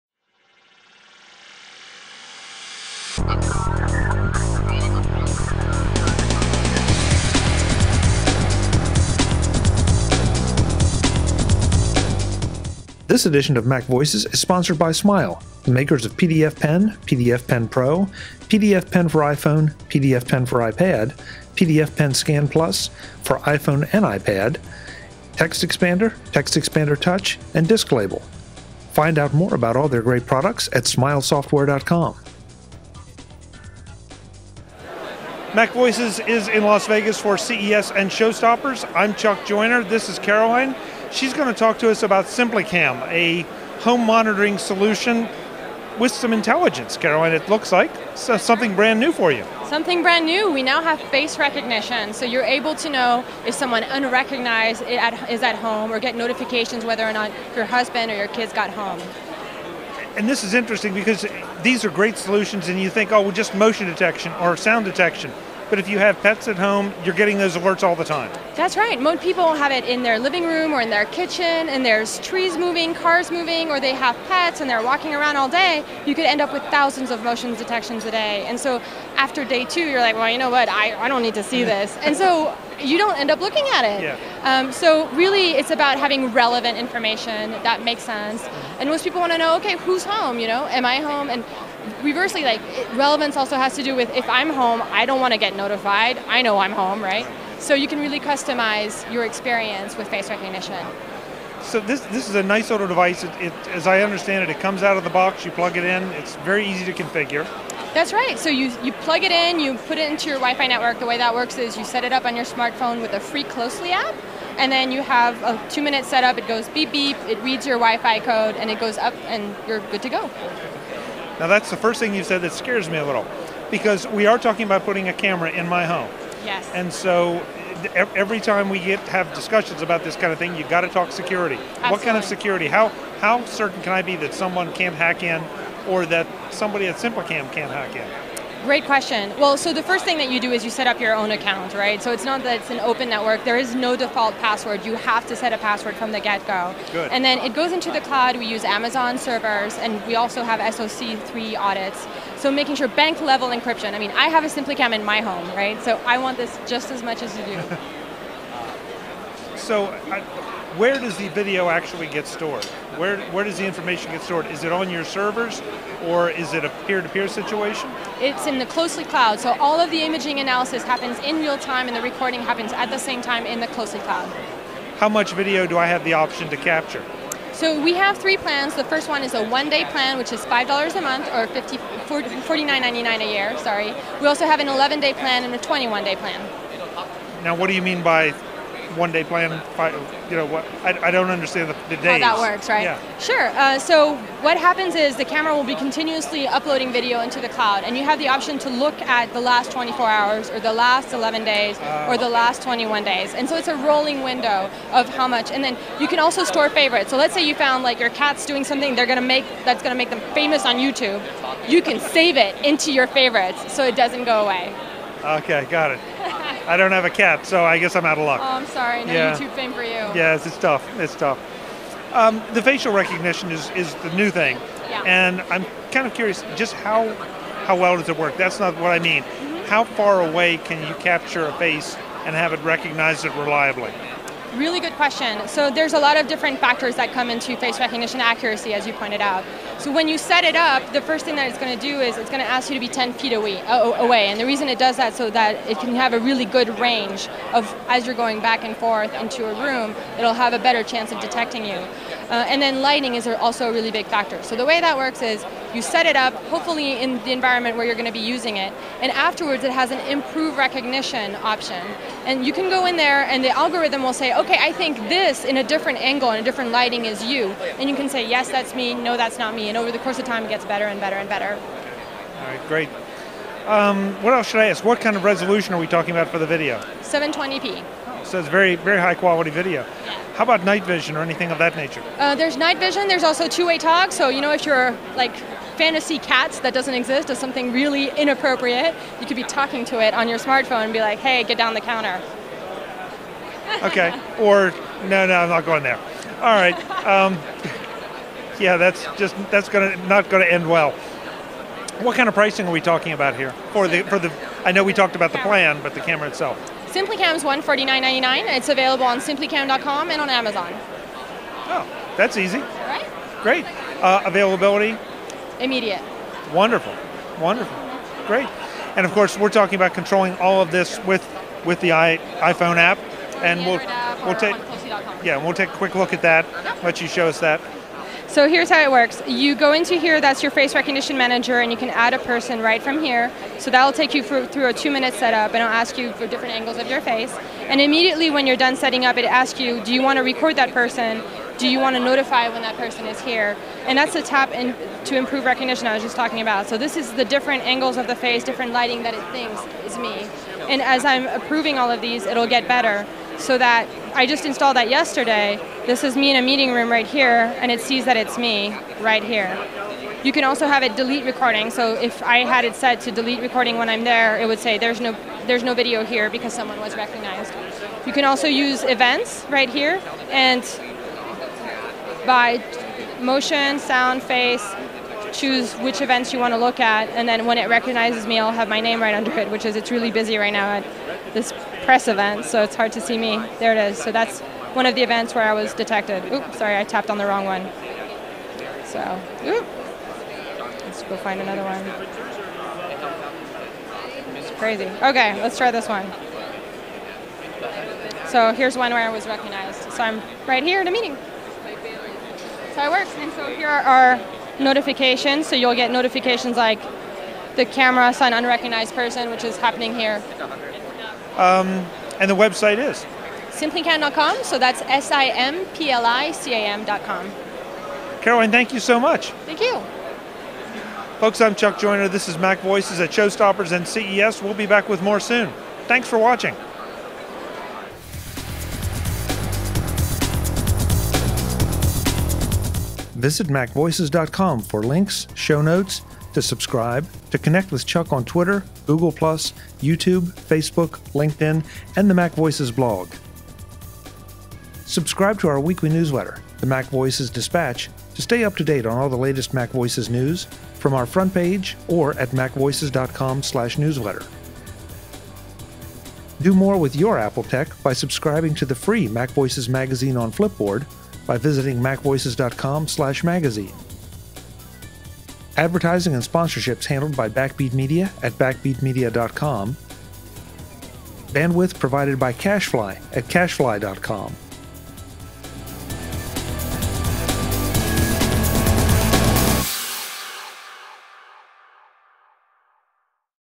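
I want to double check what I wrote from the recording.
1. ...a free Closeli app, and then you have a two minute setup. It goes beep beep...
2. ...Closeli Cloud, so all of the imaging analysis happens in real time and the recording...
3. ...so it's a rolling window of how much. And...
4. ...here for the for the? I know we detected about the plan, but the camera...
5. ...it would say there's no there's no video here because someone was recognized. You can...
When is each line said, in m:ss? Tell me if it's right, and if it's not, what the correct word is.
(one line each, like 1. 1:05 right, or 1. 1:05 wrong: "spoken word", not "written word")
1. 1:53 right
2. 2:48 right
3. 3:23 right
4. 5:03 wrong: "talked", not "detected"
5. 6:04 right.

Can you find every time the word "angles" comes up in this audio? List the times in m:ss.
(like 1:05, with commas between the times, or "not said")
4:25, 5:36, 5:47.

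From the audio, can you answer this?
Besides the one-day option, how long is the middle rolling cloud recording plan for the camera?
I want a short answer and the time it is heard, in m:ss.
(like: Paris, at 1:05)
11 days, at 3:04.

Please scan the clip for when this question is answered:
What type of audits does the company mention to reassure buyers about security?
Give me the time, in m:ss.
2:30.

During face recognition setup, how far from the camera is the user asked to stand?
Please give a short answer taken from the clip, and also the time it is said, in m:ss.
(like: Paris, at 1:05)
10 feet, at 4:02.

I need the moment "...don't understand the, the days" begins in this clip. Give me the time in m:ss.
3:11.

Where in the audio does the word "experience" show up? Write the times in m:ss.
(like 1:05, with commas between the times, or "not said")
1:39.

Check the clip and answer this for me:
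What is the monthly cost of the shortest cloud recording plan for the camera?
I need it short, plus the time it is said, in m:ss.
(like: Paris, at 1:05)
$5, at 3:00.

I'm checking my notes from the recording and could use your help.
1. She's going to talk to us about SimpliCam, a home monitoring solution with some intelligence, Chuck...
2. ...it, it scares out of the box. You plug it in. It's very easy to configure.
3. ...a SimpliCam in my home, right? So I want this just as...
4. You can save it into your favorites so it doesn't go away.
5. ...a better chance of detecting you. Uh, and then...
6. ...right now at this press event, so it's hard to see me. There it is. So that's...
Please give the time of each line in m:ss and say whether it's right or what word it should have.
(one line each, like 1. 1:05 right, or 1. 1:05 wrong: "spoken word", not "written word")
1. 0:41 wrong: "Caroline", not "Chuck"
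2. 1:44 wrong: "comes", not "scares"
3. 2:34 right
4. 3:31 right
5. 4:10 right
6. 6:20 right.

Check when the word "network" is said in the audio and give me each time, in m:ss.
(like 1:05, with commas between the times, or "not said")
1:50, 2:23.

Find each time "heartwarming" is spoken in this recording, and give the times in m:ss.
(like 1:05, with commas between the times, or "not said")
not said.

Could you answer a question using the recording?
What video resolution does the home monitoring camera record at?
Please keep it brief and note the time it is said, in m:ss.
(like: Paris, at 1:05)
720p, at 4:37.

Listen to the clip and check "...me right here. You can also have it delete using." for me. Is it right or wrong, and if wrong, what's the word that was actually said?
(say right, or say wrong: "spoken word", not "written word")
wrong: "recording", not "using".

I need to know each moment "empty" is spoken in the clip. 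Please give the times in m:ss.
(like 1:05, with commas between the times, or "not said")
not said.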